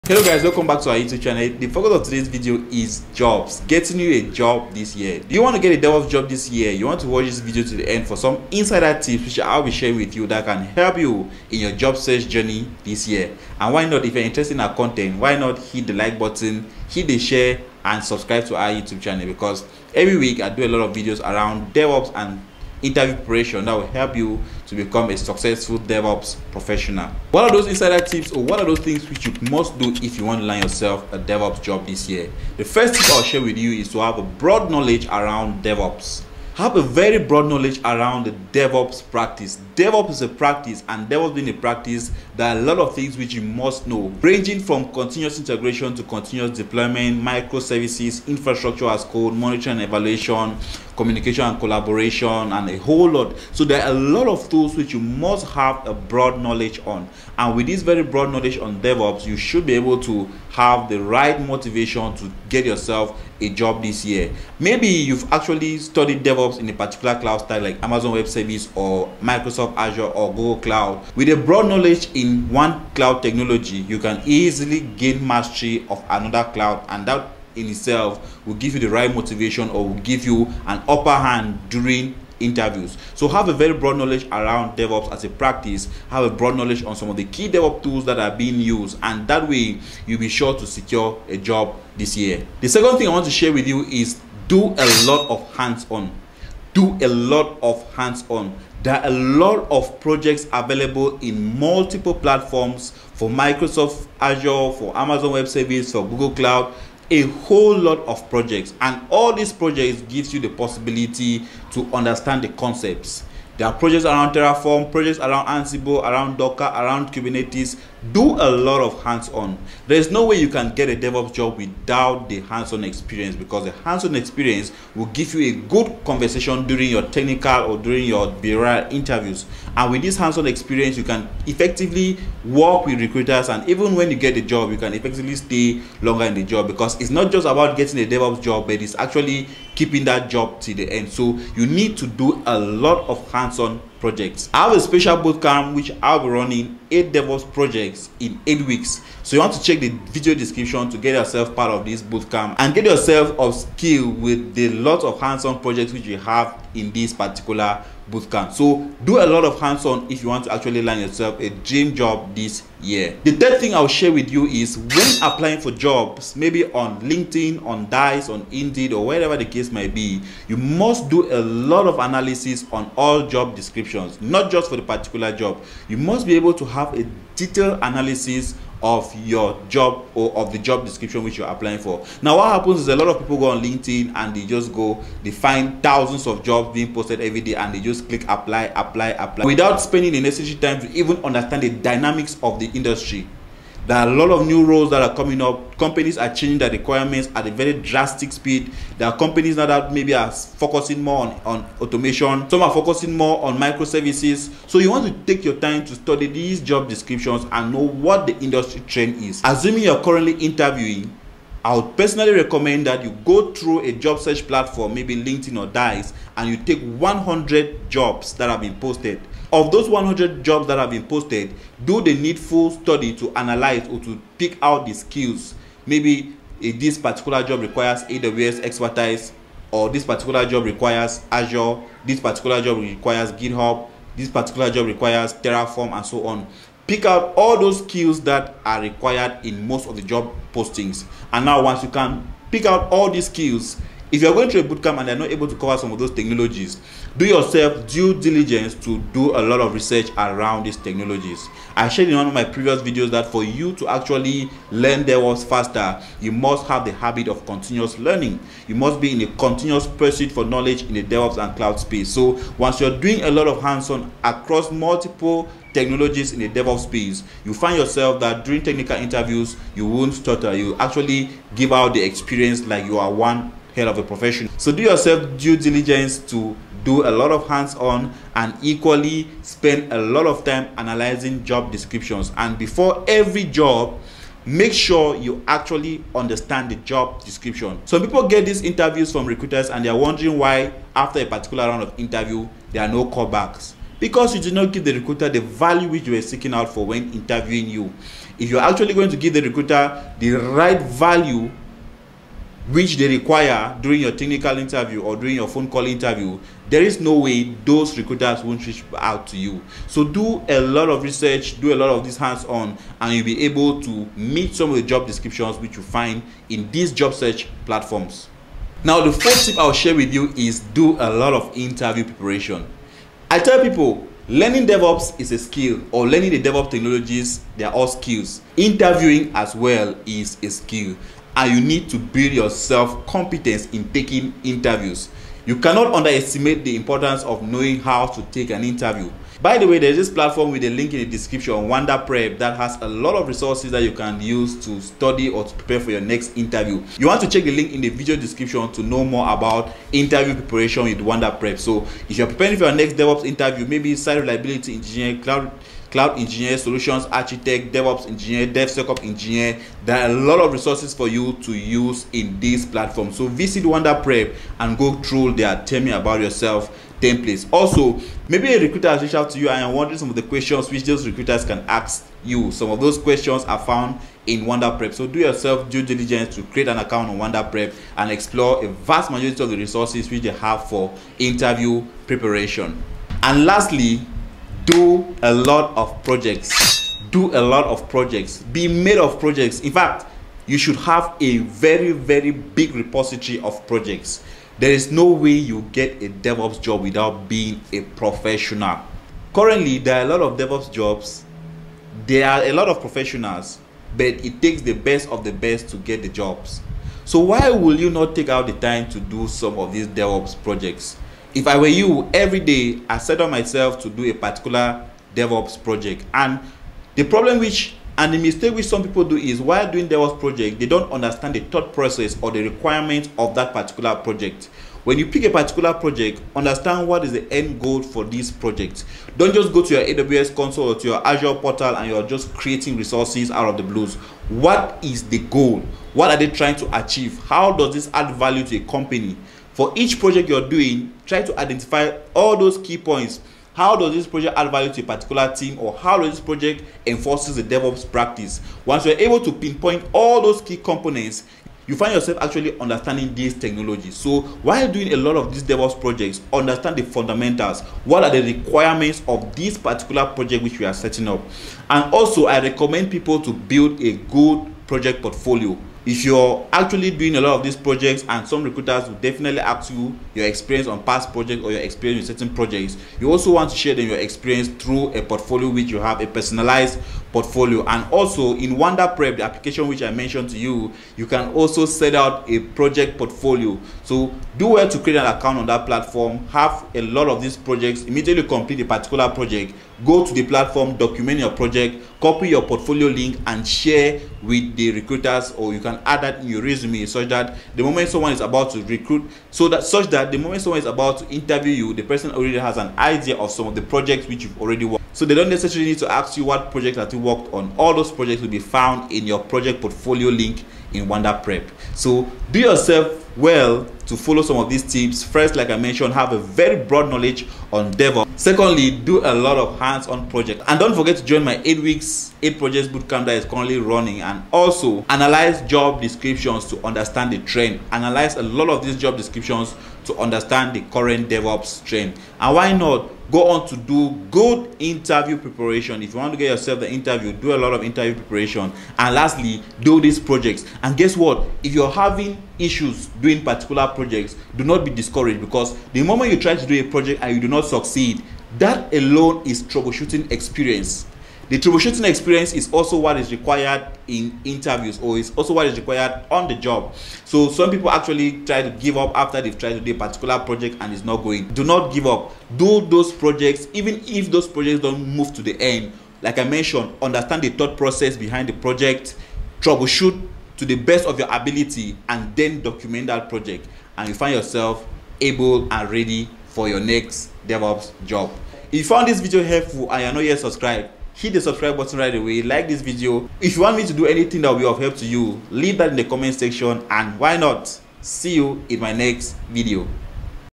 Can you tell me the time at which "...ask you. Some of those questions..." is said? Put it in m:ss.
6:11.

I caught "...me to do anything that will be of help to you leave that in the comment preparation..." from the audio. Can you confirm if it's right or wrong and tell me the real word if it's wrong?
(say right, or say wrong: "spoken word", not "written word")
wrong: "section", not "preparation".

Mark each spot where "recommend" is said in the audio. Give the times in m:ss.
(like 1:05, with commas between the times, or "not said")
3:32, 7:42.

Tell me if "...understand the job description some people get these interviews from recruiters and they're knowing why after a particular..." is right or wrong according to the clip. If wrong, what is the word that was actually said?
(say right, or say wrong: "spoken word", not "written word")
wrong: "wondering", not "knowing".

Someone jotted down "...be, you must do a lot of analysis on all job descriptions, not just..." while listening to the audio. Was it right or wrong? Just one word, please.
right.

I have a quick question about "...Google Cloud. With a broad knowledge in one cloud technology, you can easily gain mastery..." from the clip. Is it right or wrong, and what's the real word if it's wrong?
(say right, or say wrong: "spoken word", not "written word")
right.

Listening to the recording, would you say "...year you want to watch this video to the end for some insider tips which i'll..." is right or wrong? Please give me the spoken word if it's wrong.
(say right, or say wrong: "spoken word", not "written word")
right.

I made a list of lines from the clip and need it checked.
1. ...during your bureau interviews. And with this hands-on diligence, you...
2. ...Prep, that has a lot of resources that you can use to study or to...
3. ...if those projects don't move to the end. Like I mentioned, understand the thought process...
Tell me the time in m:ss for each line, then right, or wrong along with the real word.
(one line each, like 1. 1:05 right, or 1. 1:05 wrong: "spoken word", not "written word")
1. 2:07 wrong: "experience", not "diligence"
2. 5:42 right
3. 9:23 right.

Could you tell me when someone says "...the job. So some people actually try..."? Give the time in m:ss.
9:16.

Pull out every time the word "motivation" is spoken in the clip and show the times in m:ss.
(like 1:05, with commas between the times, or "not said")
1:01, 1:19.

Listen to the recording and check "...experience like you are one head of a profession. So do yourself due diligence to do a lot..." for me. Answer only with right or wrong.
right.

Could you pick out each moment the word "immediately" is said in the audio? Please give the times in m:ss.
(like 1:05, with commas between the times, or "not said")
8:07.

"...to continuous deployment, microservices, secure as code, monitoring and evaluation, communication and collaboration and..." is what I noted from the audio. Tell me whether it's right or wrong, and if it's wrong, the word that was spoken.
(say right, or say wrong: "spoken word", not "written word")
wrong: "infrastructure", not "secure".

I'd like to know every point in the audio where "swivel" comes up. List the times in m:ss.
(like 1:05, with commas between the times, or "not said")
not said.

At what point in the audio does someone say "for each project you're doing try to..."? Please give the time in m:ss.
7:19.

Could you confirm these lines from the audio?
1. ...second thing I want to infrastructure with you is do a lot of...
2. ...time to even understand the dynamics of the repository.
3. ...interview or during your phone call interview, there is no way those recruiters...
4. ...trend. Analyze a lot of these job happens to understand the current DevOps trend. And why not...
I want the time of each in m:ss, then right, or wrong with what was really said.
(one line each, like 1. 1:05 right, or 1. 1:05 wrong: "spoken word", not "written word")
1. 1:32 wrong: "share", not "infrastructure"
2. 3:10 wrong: "industry", not "repository"
3. 5:04 right
4. 8:47 wrong: "descriptions", not "happens".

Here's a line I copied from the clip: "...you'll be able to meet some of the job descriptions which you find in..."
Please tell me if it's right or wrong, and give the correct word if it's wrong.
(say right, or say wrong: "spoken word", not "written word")
right.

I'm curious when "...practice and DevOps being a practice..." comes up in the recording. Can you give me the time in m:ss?
0:40.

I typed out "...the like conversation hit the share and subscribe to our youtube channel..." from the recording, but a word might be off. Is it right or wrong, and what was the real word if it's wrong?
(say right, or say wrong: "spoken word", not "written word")
wrong: "button", not "conversation".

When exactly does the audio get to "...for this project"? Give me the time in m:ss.
7:07.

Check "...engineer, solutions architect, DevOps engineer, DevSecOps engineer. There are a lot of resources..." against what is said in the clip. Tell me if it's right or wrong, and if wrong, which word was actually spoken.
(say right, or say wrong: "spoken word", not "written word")
right.